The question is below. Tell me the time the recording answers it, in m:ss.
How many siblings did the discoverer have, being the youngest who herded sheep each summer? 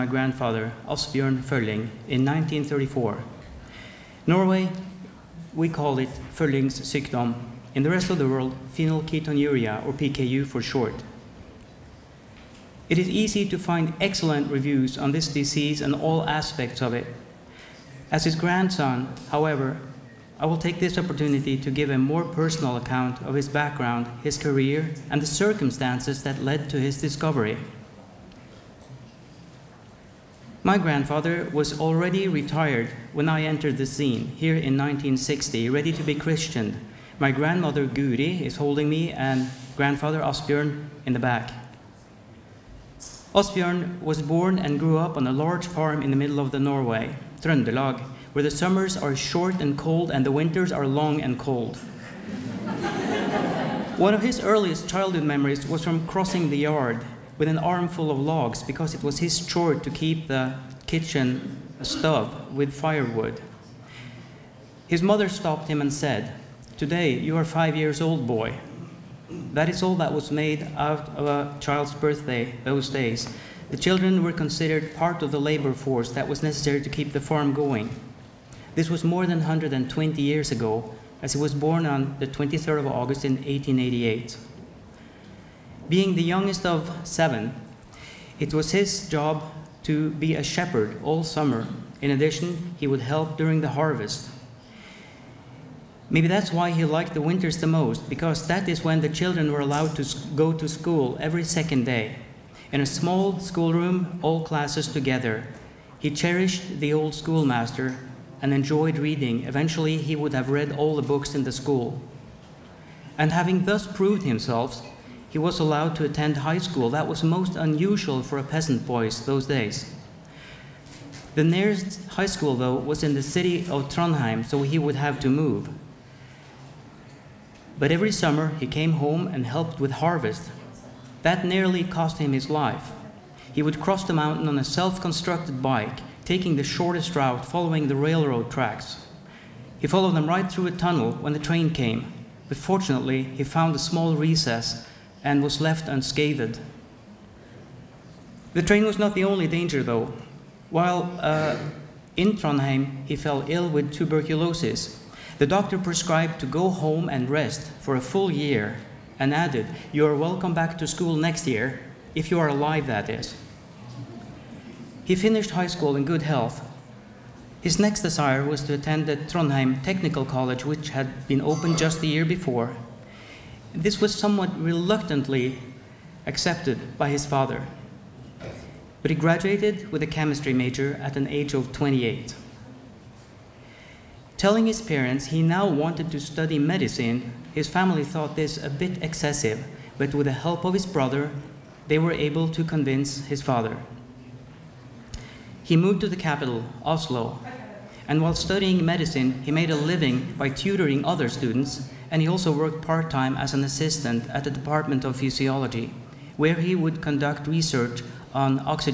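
1:27.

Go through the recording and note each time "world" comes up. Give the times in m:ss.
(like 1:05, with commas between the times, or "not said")
0:08.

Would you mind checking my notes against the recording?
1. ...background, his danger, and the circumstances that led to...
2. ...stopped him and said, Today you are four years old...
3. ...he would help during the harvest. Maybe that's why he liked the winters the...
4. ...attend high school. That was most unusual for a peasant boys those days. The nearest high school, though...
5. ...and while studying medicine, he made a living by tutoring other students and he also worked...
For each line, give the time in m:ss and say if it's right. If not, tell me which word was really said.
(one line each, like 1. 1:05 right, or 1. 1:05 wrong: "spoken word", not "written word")
1. 0:23 wrong: "career", not "danger"
2. 1:05 wrong: "five", not "four"
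3. 1:32 right
4. 1:56 right
5. 3:18 right.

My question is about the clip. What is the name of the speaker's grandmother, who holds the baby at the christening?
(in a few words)
Guri.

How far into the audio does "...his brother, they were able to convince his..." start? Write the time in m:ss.
3:10.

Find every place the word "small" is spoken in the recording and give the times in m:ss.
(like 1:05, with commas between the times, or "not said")
1:42, 2:23.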